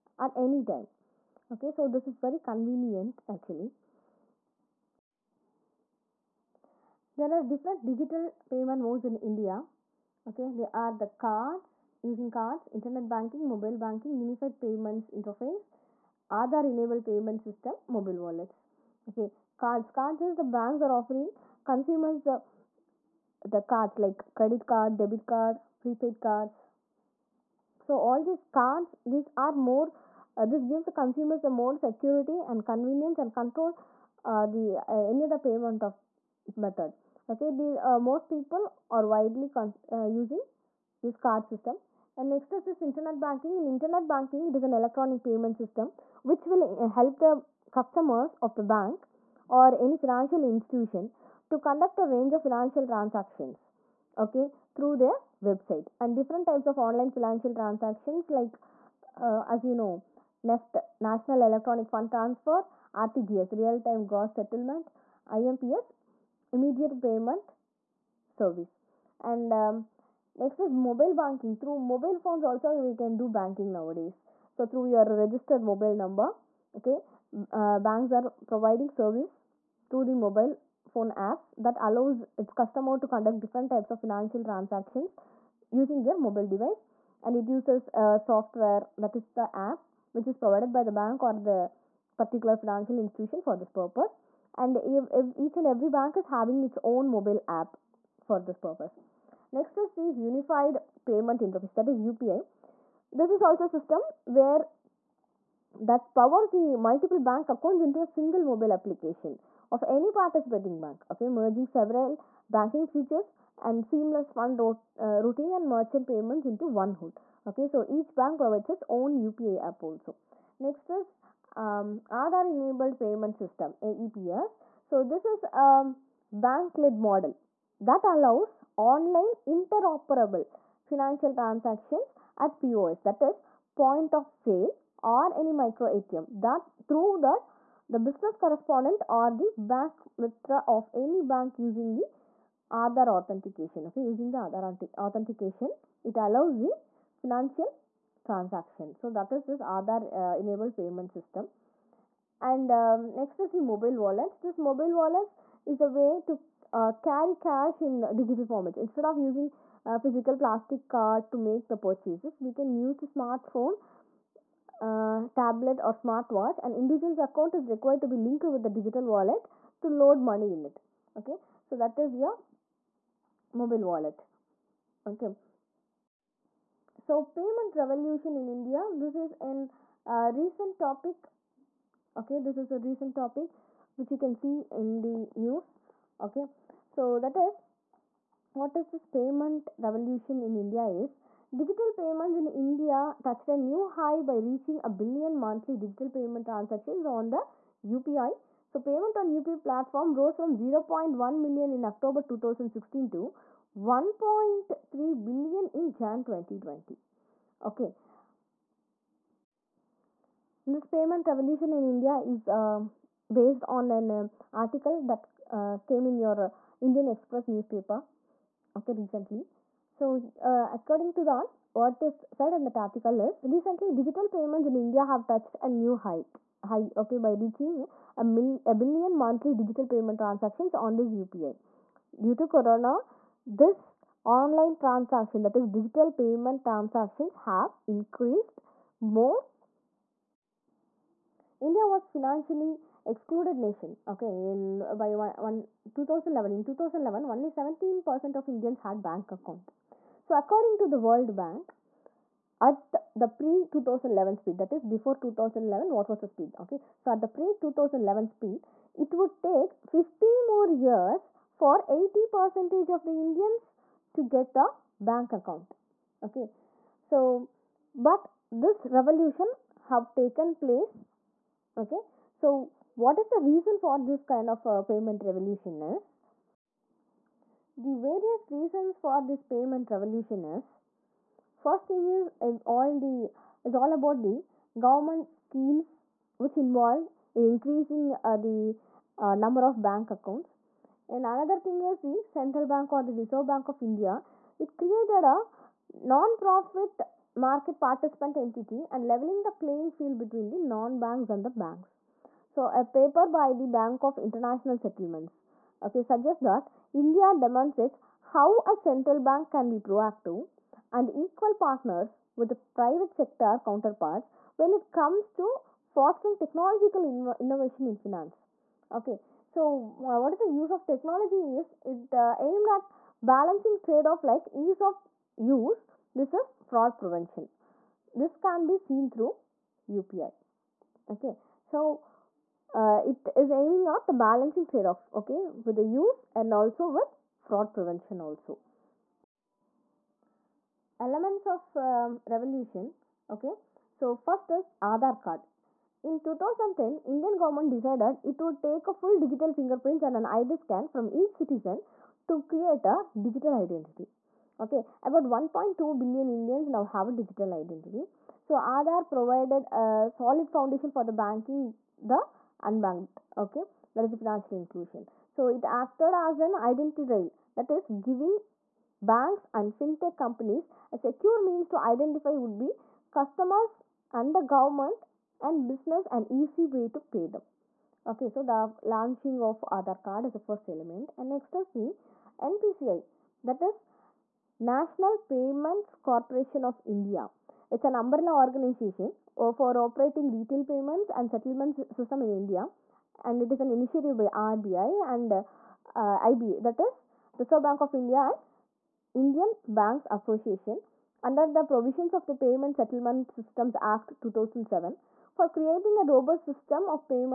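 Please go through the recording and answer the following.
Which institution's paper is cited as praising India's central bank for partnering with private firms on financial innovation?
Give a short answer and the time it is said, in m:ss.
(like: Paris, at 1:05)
Bank of International Settlements, at 5:03.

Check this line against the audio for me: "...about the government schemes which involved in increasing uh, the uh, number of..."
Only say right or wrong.
right.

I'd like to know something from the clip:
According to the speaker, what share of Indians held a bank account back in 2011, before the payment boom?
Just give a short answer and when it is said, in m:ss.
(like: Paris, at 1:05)
17%, at 4:07.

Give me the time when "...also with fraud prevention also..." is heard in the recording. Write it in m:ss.
5:36.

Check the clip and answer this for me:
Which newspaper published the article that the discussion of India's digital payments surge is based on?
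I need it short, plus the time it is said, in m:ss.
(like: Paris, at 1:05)
Indian Express, at 3:36.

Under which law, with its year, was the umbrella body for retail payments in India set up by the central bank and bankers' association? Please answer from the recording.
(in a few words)
Payment Settlement Systems Act 2007.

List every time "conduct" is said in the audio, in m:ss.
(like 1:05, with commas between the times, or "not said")
0:51, 1:23.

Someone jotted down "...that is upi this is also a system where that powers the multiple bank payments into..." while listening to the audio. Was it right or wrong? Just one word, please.
wrong.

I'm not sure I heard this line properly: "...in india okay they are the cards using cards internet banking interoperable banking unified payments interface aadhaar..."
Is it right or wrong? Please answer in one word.
wrong.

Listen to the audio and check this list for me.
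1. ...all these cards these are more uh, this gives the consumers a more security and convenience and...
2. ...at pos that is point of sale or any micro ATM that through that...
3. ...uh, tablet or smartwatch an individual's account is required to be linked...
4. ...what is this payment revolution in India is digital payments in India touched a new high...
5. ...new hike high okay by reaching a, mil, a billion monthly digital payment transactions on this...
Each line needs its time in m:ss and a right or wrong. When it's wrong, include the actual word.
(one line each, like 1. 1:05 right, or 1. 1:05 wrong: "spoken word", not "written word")
1. 0:27 right
2. 2:12 right
3. 2:44 right
4. 3:08 right
5. 3:45 right.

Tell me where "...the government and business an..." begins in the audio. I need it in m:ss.
6:14.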